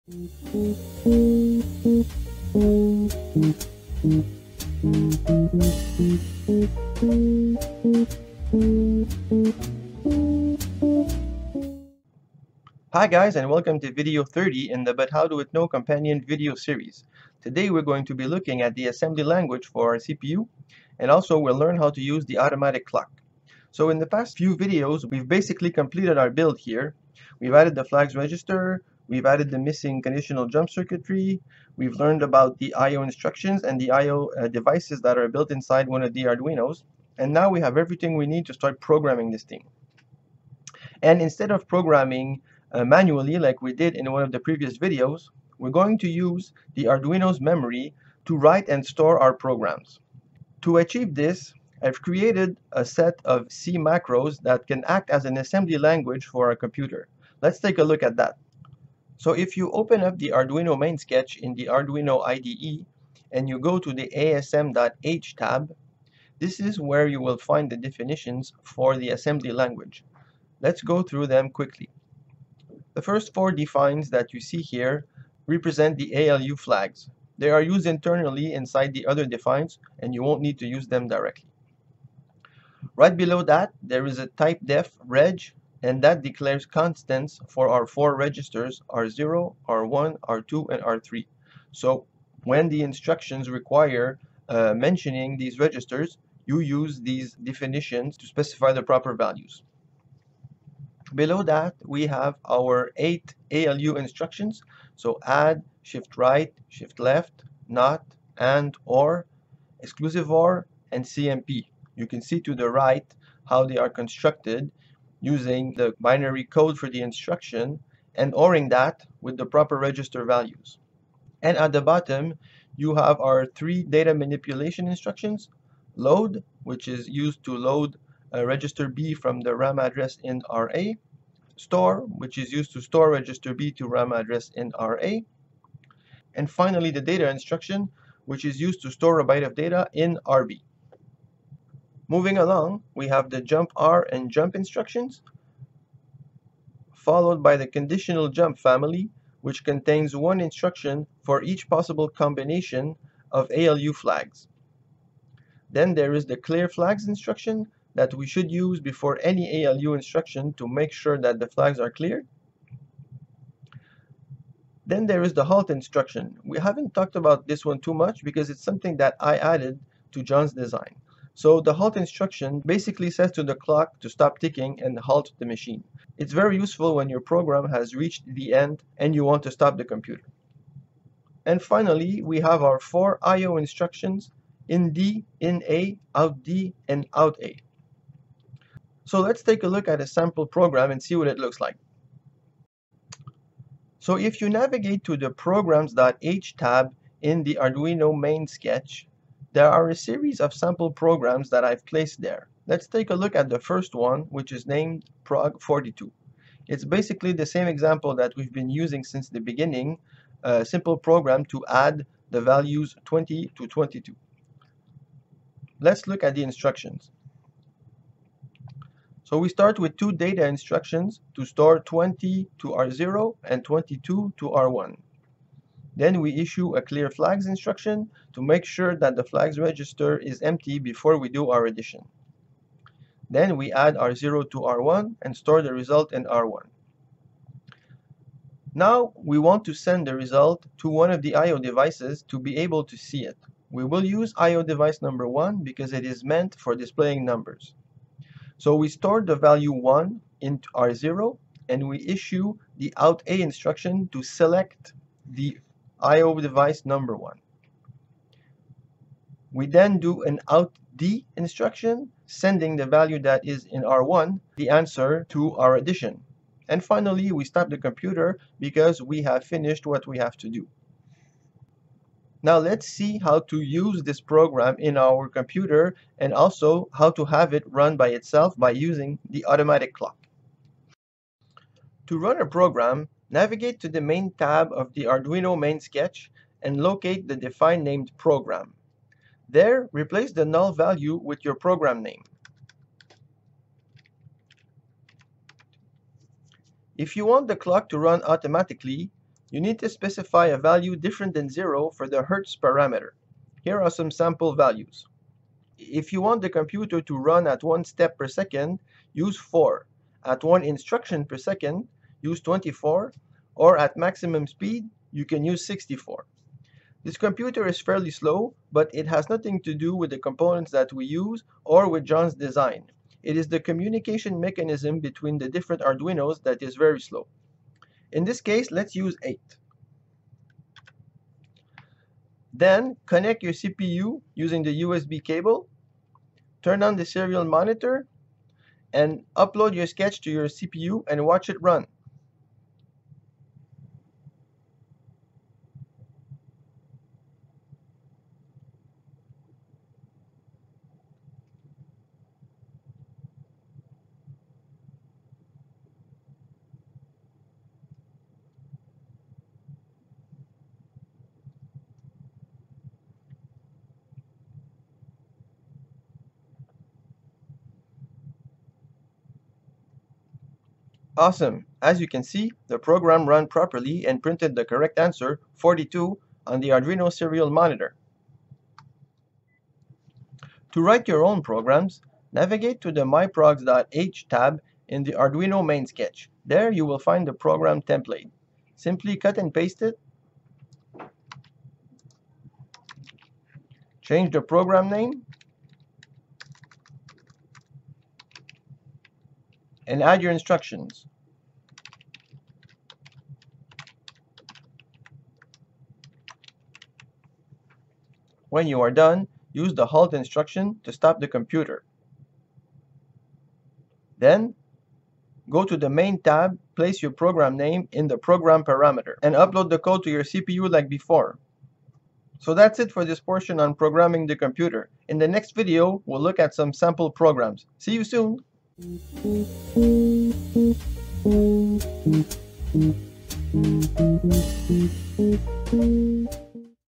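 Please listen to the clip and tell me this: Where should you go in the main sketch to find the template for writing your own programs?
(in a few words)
myprogs.h tab.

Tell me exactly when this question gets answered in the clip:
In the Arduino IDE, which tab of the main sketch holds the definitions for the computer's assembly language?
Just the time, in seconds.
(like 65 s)
64 s.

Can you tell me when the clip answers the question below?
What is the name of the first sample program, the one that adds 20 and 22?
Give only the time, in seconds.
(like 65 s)
205 s.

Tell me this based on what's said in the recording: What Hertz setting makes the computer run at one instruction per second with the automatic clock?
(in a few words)
24.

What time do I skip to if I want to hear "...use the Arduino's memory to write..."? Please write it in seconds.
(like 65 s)
46 s.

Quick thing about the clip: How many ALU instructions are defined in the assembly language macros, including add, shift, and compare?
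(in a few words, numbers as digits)
8.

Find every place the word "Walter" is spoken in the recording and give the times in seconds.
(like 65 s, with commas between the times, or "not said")
not said.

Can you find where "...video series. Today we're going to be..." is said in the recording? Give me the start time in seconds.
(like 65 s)
16 s.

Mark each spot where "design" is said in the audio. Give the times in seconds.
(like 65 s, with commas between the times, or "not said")
170 s, 322 s.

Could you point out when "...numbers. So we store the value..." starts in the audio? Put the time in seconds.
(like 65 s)
247 s.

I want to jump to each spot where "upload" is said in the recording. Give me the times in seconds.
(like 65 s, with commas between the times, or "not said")
339 s, 419 s.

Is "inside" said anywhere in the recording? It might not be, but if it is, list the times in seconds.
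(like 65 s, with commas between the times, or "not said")
35 s, 78 s.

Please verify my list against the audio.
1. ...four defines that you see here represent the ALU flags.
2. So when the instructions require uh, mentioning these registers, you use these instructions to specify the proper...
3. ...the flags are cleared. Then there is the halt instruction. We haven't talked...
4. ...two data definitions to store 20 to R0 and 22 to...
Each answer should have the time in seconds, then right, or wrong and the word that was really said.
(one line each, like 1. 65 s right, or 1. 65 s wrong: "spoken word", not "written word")
1. 73 s right
2. 91 s wrong: "definitions", not "instructions"
3. 161 s right
4. 219 s wrong: "instructions", not "definitions".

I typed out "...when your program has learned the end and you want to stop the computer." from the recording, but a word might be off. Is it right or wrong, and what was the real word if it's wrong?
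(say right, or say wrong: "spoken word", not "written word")
wrong: "reached", not "learned".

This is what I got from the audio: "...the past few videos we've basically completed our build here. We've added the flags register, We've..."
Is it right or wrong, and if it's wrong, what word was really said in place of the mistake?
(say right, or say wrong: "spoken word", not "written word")
right.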